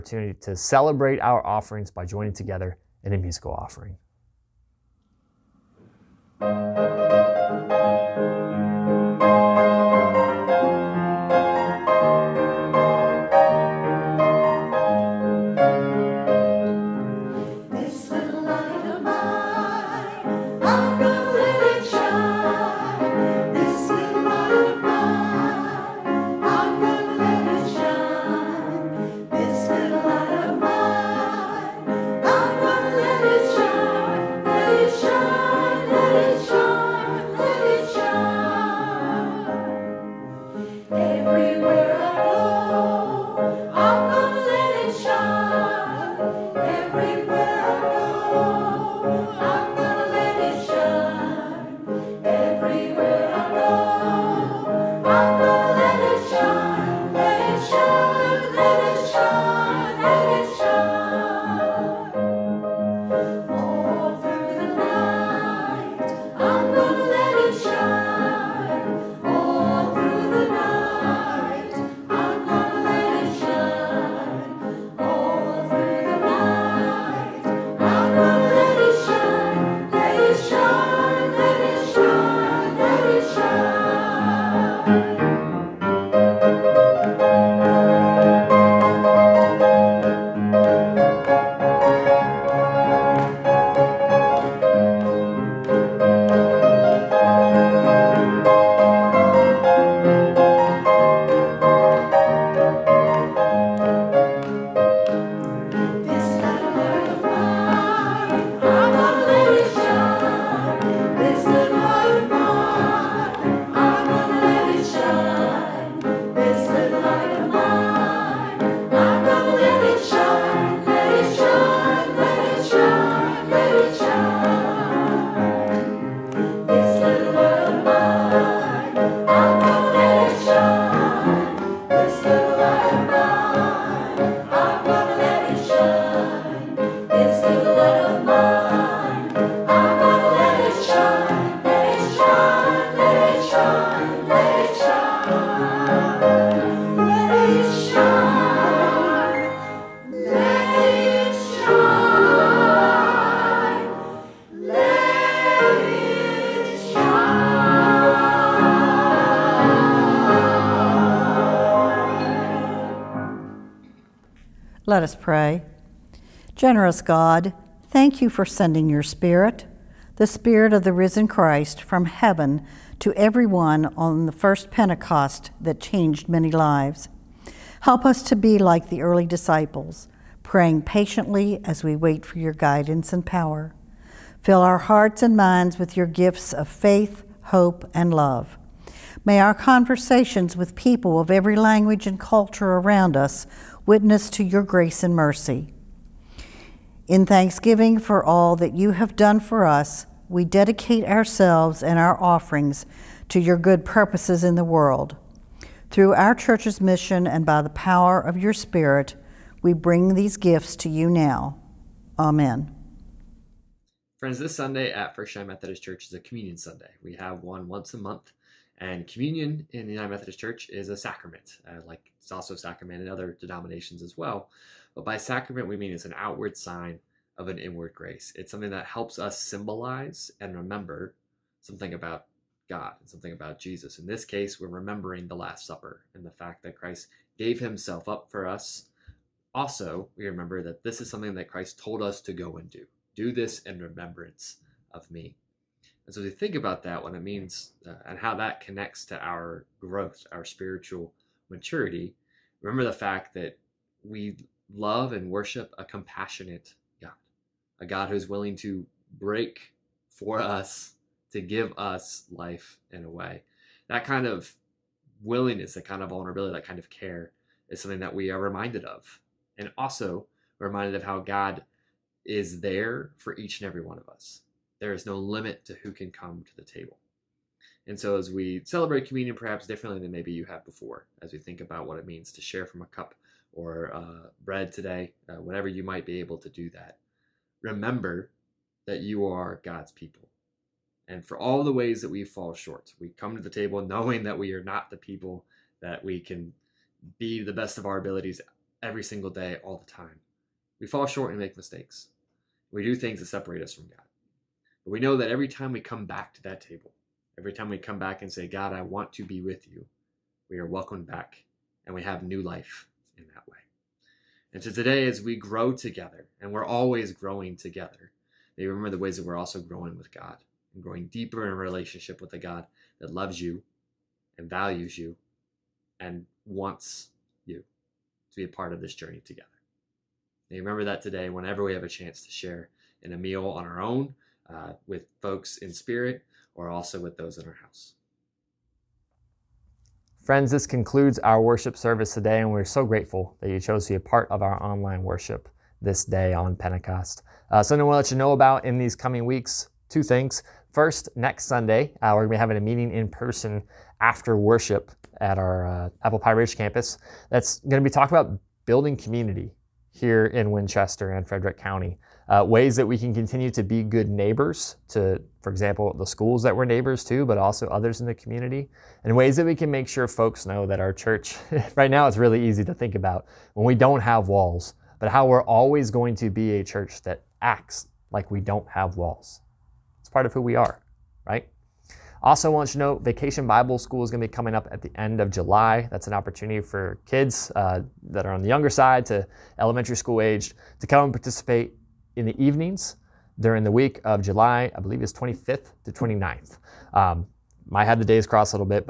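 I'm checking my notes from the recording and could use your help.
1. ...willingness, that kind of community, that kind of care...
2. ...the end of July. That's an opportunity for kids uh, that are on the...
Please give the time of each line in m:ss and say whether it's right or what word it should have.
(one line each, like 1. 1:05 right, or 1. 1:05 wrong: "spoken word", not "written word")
1. 4:25 wrong: "vulnerability", not "community"
2. 6:24 right.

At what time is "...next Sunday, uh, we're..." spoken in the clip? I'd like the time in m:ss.
5:51.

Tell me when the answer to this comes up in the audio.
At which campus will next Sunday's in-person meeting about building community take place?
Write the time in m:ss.
5:56.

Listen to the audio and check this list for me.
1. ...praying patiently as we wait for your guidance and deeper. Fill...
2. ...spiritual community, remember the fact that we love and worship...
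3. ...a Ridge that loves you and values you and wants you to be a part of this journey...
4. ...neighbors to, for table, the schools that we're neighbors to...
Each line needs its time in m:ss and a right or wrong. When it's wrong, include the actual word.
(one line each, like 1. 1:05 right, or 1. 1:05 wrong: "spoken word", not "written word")
1. 3:00 wrong: "power", not "deeper"
2. 4:10 wrong: "maturity", not "community"
3. 5:22 wrong: "God", not "Ridge"
4. 6:04 wrong: "example", not "table".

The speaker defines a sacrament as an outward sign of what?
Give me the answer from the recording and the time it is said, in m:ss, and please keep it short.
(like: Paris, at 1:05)
An inward grace, at 3:47.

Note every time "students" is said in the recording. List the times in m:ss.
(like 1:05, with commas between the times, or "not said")
not said.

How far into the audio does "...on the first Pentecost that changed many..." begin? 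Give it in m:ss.
2:53.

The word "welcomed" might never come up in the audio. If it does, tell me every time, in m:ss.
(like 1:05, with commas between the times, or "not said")
5:10.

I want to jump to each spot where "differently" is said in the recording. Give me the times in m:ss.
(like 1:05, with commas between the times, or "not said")
4:39.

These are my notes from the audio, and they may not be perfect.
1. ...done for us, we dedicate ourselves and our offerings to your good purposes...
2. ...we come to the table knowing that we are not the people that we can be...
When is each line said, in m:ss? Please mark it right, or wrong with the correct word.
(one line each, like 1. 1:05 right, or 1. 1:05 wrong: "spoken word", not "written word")
1. 3:19 right
2. 4:52 right.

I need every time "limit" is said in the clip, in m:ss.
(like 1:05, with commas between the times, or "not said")
4:35.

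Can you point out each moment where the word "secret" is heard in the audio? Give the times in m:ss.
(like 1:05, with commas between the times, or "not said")
not said.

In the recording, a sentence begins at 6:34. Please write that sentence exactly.
I believe it's 25th to 29th.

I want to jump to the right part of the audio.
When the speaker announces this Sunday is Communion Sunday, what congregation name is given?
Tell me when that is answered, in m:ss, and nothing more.
3:35.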